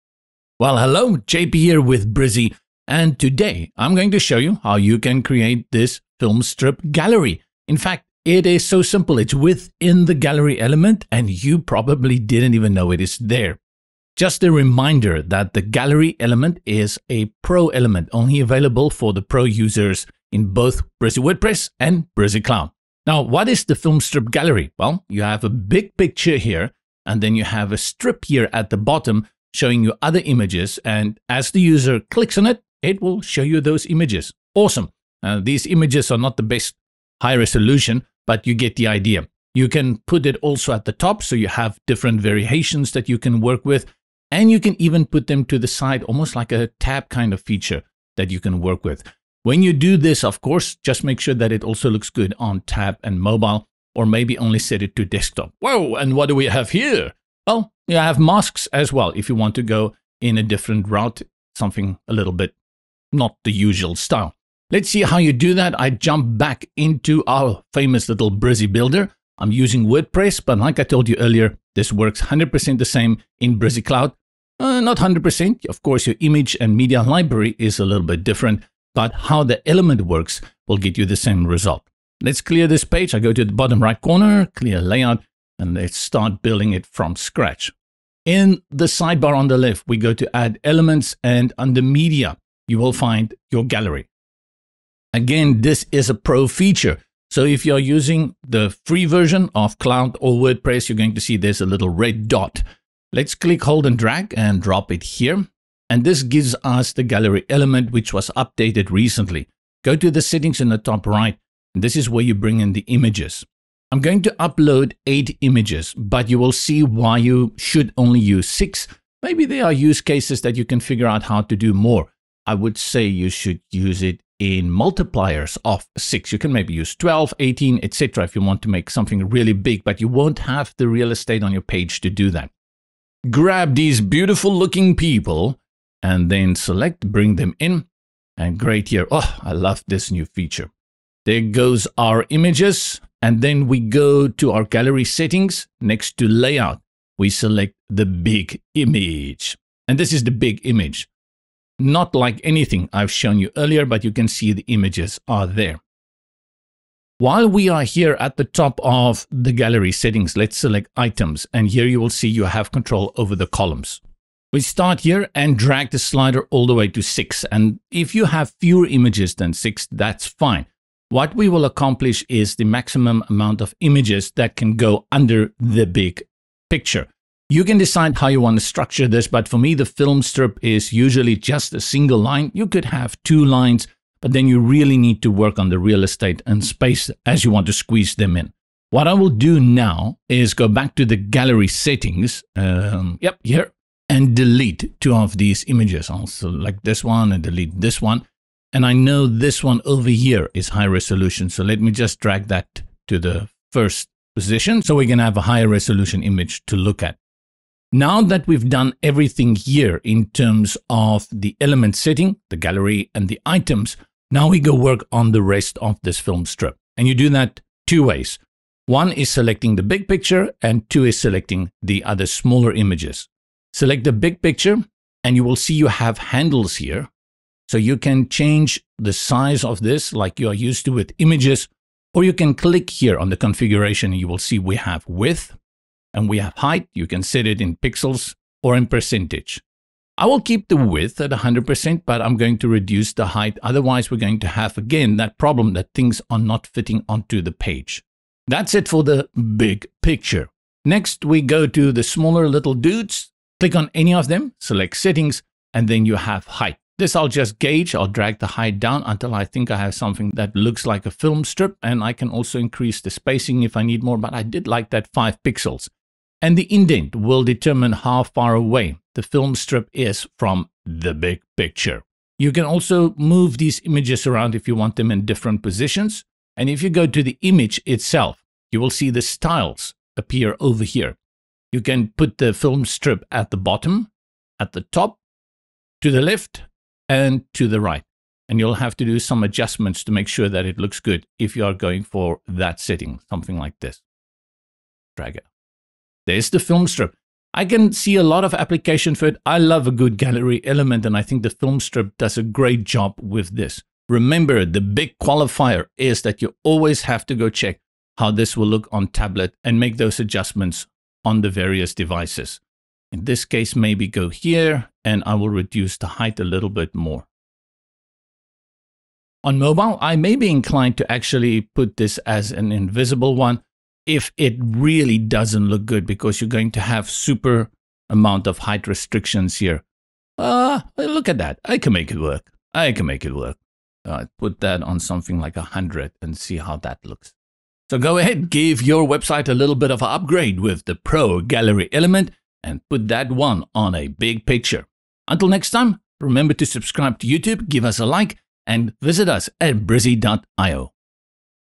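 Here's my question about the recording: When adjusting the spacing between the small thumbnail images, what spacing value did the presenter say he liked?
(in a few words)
5 pixels.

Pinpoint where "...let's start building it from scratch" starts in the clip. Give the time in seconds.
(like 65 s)
85 s.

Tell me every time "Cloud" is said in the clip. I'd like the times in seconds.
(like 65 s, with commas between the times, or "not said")
22 s, 73 s, 99 s.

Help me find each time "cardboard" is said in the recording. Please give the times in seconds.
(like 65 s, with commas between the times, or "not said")
not said.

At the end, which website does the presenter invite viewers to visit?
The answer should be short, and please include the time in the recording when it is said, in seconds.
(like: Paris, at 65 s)
brizy.io, at 349 s.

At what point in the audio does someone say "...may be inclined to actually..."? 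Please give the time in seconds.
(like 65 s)
320 s.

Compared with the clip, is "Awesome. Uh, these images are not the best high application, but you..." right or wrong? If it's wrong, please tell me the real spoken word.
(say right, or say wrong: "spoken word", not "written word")
wrong: "resolution", not "application".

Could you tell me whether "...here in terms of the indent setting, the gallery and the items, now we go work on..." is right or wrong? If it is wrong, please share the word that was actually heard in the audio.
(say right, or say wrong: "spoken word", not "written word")
wrong: "element", not "indent".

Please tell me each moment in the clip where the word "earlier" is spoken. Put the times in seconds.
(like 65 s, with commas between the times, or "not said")
71 s, 153 s.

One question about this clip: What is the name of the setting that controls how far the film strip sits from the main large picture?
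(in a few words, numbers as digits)
indent.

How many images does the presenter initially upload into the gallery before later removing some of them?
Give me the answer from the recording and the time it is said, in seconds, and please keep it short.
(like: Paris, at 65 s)
8, at 115 s.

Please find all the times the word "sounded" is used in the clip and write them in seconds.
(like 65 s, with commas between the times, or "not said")
not said.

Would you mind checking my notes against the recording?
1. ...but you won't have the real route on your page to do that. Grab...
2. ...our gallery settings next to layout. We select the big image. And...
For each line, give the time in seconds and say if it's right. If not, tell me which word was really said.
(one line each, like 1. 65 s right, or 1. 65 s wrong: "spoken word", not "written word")
1. 129 s wrong: "estate", not "route"
2. 144 s right.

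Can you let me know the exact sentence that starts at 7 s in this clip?
In fact, it is so simple.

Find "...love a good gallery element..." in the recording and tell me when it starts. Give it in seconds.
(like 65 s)
299 s.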